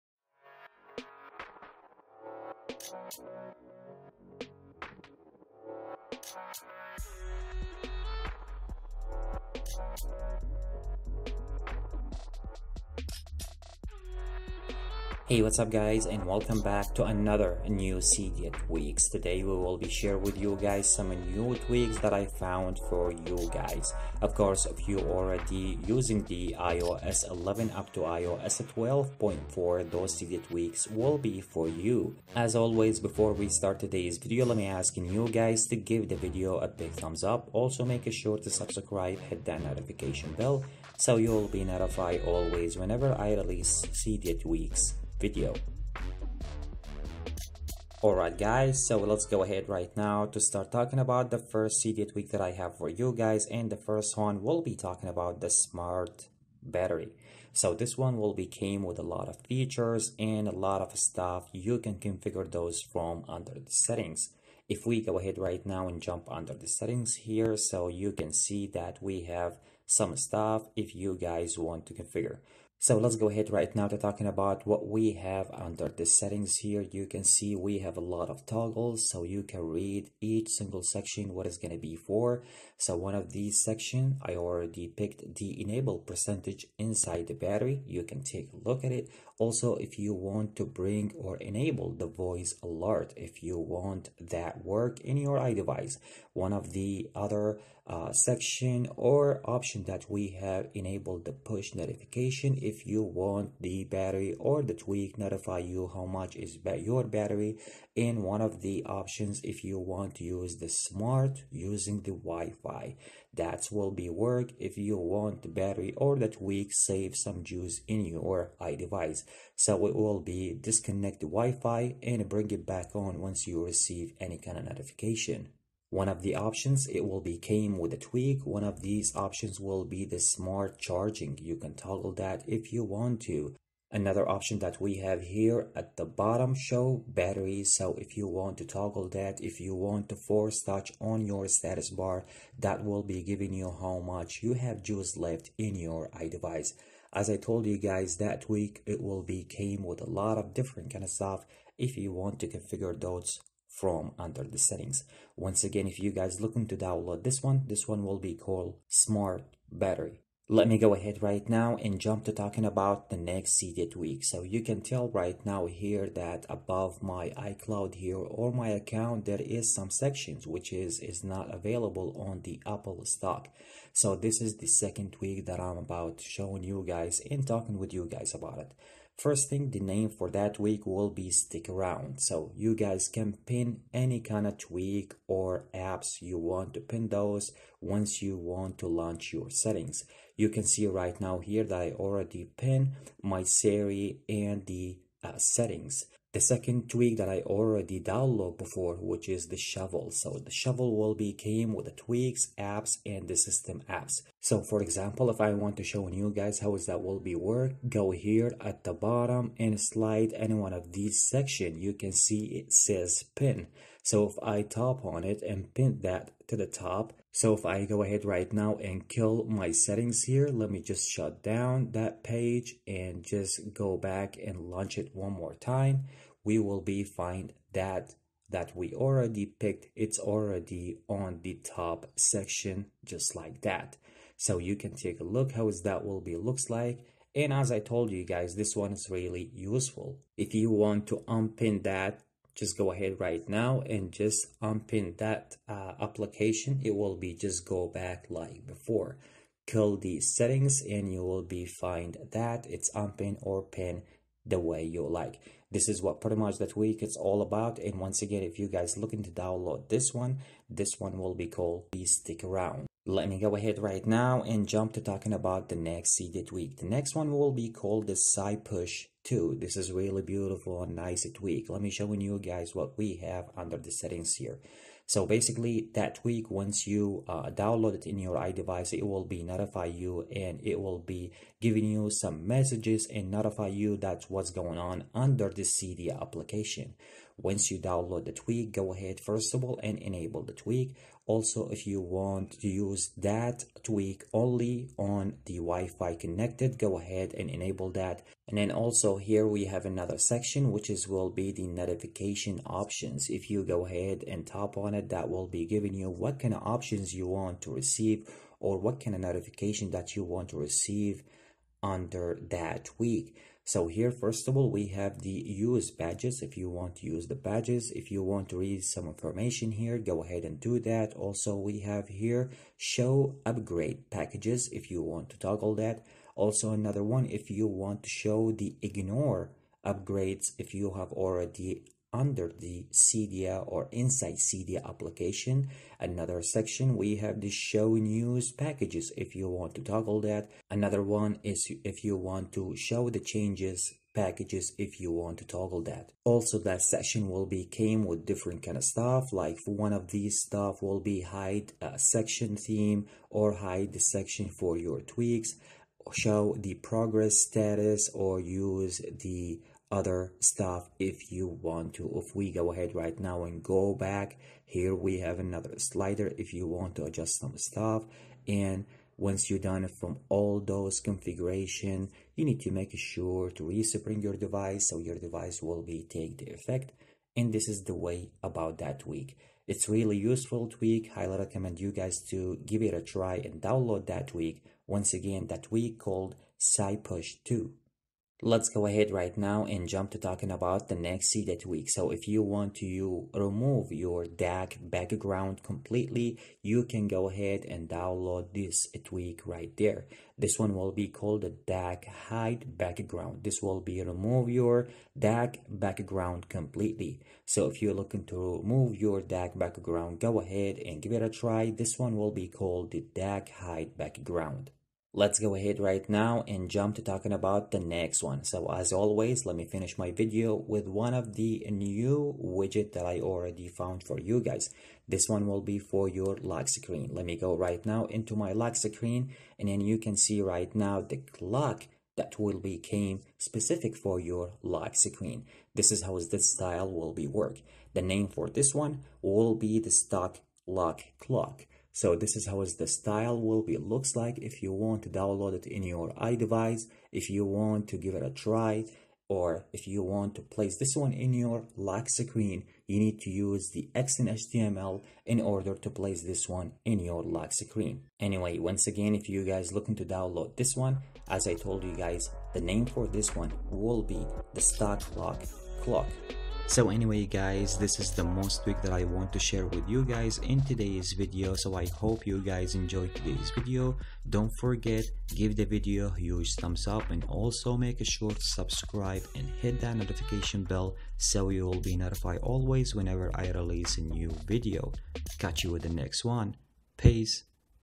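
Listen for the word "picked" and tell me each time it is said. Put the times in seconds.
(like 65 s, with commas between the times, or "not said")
84 s, 229 s.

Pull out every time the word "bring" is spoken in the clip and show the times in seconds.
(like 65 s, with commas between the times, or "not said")
90 s, 122 s.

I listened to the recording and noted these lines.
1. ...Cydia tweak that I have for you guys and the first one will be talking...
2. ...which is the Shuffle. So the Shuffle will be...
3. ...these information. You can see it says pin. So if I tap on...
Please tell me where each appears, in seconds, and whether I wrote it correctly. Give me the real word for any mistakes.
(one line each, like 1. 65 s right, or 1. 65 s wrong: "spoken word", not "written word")
1. 51 s right
2. 198 s right
3. 210 s wrong: "section", not "information".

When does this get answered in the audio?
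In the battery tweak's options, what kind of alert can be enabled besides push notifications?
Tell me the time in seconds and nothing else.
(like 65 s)
92 s.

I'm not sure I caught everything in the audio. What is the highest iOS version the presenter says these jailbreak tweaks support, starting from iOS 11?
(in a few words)
iOS 12.4.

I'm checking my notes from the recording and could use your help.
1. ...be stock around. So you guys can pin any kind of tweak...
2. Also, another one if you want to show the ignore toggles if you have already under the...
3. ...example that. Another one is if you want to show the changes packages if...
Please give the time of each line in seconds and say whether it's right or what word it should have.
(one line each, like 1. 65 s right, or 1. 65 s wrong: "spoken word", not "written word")
1. 181 s wrong: "stick", not "stock"
2. 326 s wrong: "upgrades", not "toggles"
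3. 339 s wrong: "toggle", not "example".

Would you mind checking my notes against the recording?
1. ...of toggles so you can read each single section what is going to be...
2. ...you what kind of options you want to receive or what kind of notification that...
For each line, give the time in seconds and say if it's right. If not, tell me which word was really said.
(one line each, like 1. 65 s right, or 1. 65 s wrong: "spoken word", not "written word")
1. 78 s right
2. 305 s right.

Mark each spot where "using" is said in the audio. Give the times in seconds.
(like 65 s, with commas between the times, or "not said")
25 s, 111 s.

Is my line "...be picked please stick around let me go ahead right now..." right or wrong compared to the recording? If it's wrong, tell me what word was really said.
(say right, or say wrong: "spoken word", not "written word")
wrong: "called", not "picked".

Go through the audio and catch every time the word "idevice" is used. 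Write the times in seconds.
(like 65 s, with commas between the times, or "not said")
95 s, 118 s, 146 s, 278 s, 446 s.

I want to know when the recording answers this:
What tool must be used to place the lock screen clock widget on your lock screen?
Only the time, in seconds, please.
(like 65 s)
453 s.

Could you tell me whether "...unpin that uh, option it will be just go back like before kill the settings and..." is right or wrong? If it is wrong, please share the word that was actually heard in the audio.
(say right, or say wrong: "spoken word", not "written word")
wrong: "application", not "option".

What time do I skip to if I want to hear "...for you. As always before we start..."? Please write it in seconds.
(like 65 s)
31 s.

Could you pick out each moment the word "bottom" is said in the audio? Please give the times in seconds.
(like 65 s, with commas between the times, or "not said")
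136 s, 208 s.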